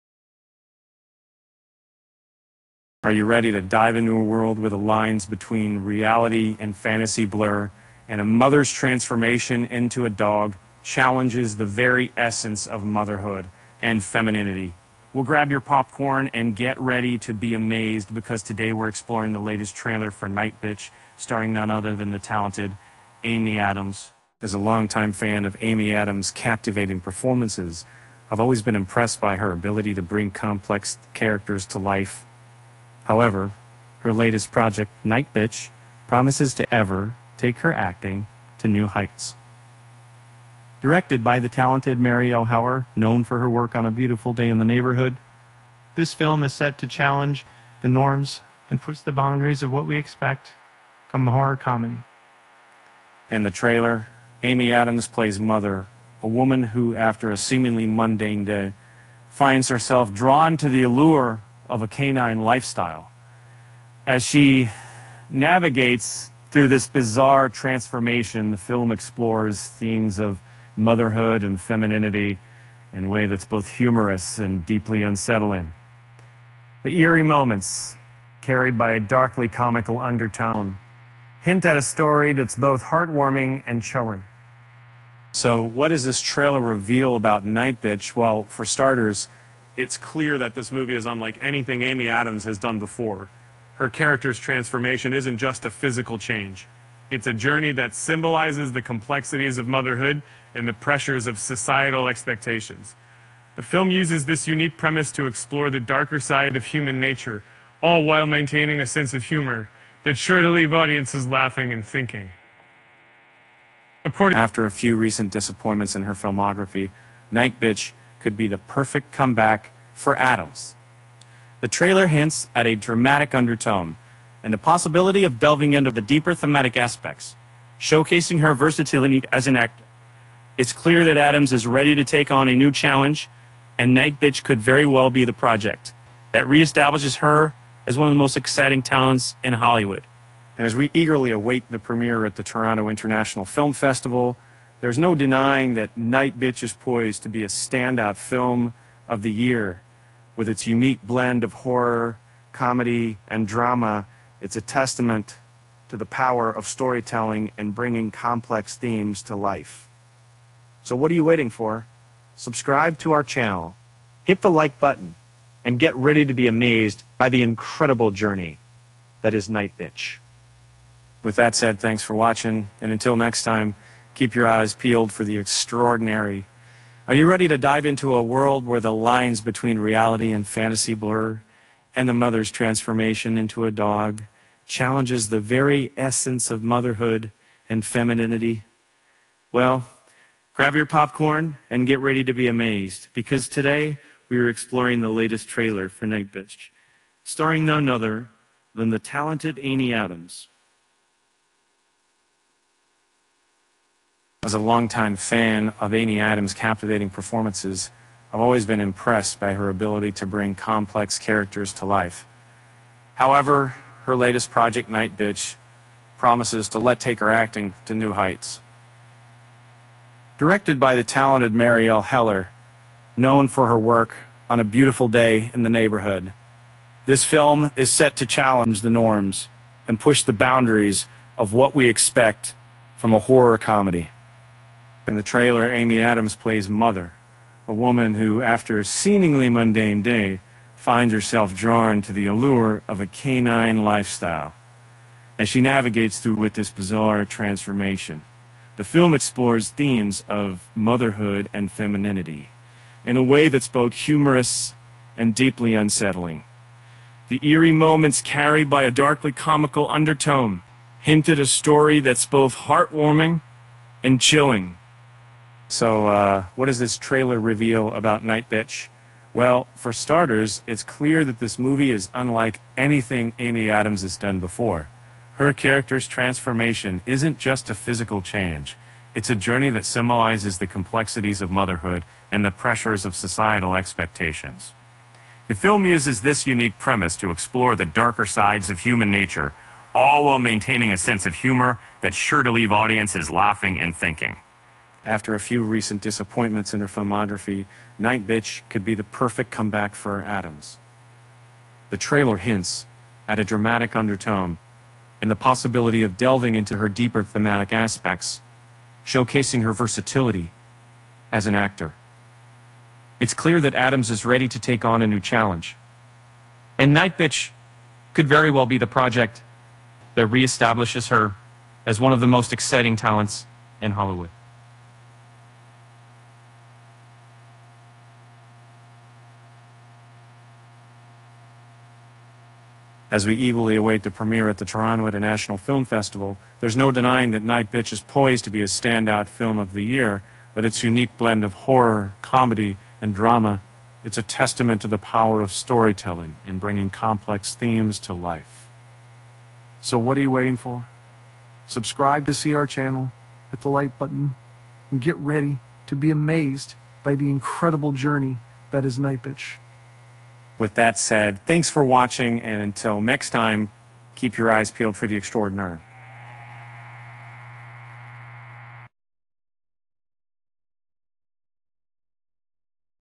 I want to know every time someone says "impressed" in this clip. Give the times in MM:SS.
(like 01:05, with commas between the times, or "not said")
00:28, 03:28.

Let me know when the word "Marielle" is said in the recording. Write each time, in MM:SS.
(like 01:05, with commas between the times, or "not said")
00:41, 03:41.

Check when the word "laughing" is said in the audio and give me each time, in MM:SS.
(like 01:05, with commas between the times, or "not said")
01:51, 04:53.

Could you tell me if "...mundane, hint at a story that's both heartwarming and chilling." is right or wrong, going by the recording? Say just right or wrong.
wrong.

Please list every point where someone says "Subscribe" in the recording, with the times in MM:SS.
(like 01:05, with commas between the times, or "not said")
02:42, 05:51.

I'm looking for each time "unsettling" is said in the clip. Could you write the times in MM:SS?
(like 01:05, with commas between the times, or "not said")
01:15, 04:15.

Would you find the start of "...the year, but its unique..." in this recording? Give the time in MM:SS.
05:39.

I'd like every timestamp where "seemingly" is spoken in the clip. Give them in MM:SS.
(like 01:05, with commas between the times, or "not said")
00:57, 03:58.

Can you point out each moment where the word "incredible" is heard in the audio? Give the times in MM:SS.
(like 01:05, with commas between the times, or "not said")
02:47, 05:57.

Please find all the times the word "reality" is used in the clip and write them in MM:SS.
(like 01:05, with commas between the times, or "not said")
00:05, 02:59.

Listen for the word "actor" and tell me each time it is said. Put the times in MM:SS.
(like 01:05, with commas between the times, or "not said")
02:09, 05:11.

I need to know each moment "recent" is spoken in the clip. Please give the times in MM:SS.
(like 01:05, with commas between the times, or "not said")
01:54, 04:55.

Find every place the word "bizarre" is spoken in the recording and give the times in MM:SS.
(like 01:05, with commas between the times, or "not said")
01:06, 04:06.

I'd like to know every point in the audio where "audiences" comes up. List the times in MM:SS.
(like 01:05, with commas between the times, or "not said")
01:50, 04:52.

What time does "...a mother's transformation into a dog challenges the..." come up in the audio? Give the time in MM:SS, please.
00:08.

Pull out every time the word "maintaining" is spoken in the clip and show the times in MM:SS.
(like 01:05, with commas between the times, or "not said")
01:48, 04:50.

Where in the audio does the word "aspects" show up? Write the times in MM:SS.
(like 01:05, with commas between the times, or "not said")
02:06, 05:07.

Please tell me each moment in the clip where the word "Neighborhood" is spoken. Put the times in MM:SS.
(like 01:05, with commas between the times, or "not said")
00:44, 03:45.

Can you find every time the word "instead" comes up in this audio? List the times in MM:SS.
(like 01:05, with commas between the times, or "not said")
not said.